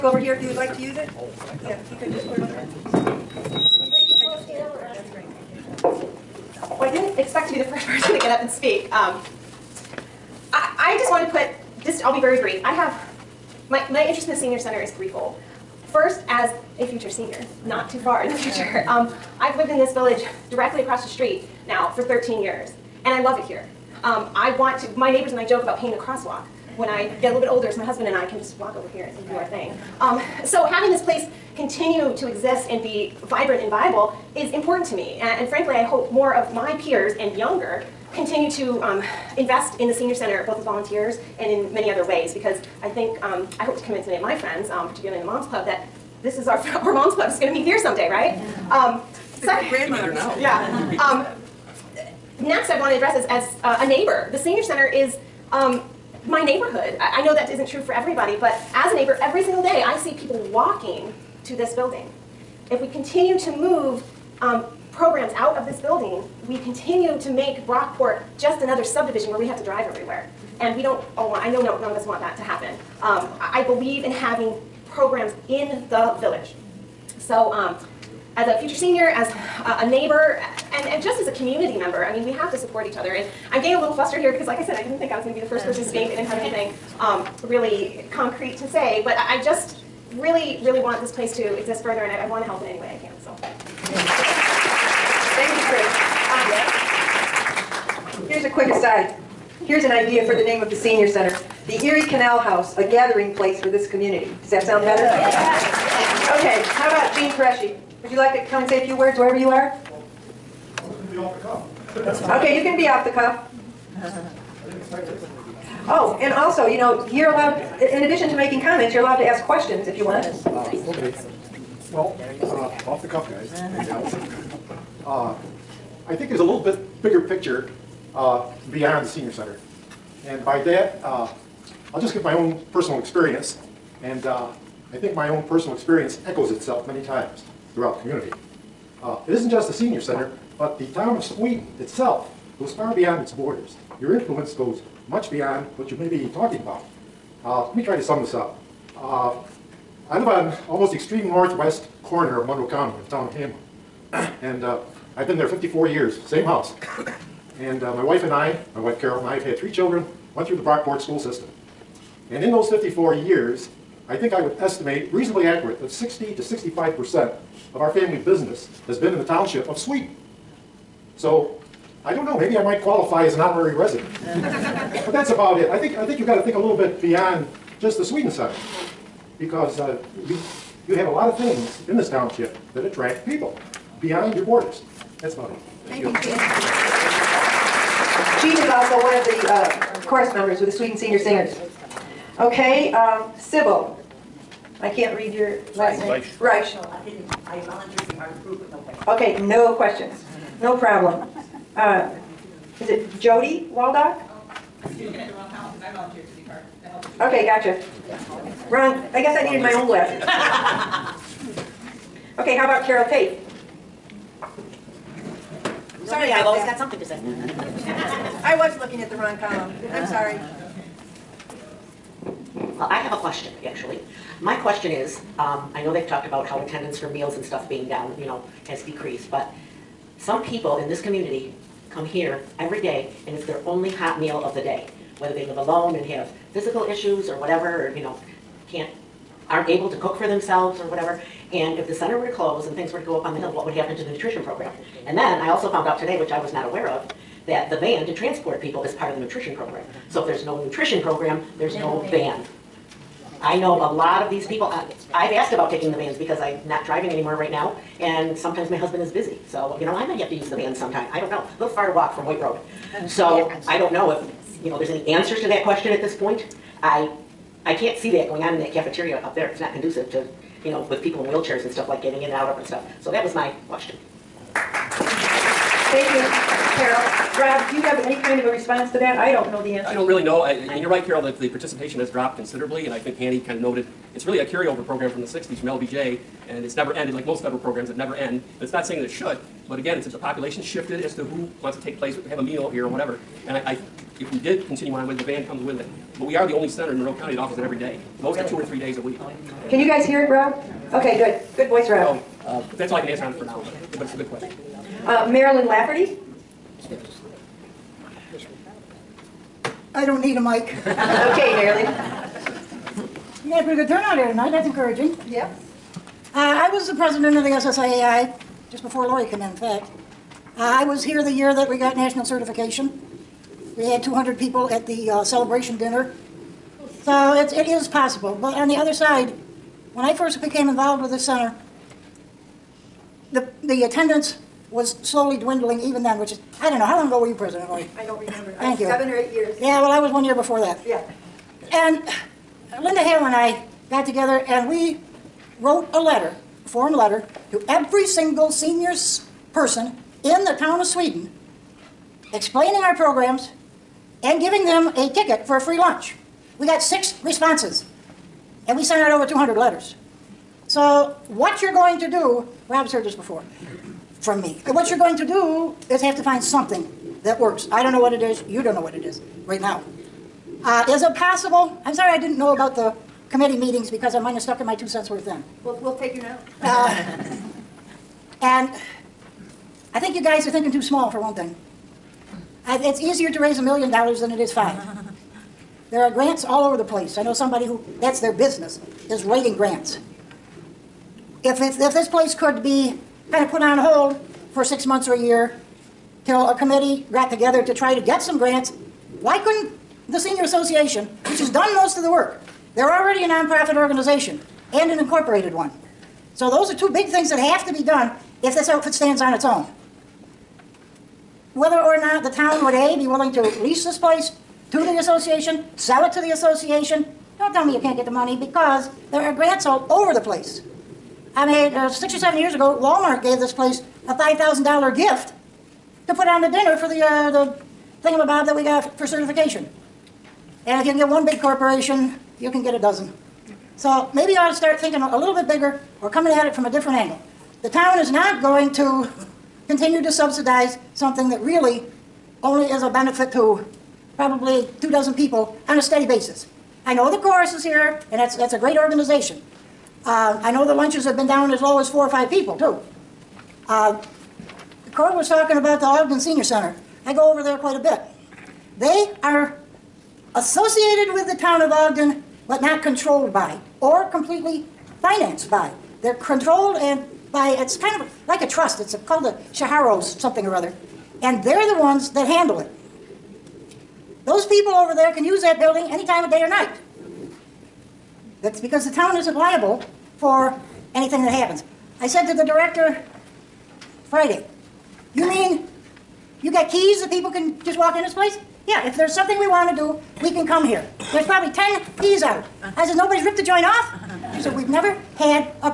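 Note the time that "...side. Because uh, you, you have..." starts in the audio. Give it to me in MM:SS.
02:58.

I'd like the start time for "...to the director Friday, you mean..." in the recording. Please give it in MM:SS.
08:02.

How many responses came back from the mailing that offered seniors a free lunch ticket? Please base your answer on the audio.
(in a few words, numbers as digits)
6.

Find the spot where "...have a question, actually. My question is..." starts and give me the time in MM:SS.
03:42.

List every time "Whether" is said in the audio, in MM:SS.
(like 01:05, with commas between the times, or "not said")
03:55, 06:51.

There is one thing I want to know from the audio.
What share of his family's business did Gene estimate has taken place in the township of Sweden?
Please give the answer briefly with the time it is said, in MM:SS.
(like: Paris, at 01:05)
60 to 65%, at 02:45.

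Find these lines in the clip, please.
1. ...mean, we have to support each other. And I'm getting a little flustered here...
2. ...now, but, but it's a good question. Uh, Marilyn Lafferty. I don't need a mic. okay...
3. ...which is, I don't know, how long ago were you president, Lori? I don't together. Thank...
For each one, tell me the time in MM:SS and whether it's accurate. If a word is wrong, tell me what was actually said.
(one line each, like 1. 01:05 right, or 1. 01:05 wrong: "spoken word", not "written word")
1. 01:22 right
2. 05:03 right
3. 05:36 wrong: "remember", not "together".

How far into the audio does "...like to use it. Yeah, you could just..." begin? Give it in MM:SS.
00:00.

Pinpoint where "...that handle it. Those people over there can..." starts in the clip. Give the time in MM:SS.
07:52.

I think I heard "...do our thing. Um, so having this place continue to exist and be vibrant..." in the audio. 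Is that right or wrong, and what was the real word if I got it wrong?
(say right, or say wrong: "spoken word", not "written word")
right.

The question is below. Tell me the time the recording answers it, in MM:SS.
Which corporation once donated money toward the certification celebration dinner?
07:02.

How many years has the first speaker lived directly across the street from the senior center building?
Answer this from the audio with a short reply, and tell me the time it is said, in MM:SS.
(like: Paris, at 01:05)
13, at 00:22.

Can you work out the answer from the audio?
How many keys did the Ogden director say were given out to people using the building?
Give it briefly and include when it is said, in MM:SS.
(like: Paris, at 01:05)
10, at 08:11.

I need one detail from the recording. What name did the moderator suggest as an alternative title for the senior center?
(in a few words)
The Erie Canal House.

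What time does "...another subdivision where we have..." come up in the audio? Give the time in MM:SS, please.
01:08.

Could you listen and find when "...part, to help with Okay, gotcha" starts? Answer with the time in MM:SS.
03:26.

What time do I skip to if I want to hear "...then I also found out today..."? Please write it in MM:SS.
04:05.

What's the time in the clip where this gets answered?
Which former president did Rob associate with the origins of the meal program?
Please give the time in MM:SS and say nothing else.
04:45.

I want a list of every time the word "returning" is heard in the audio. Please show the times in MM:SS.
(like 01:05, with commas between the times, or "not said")
not said.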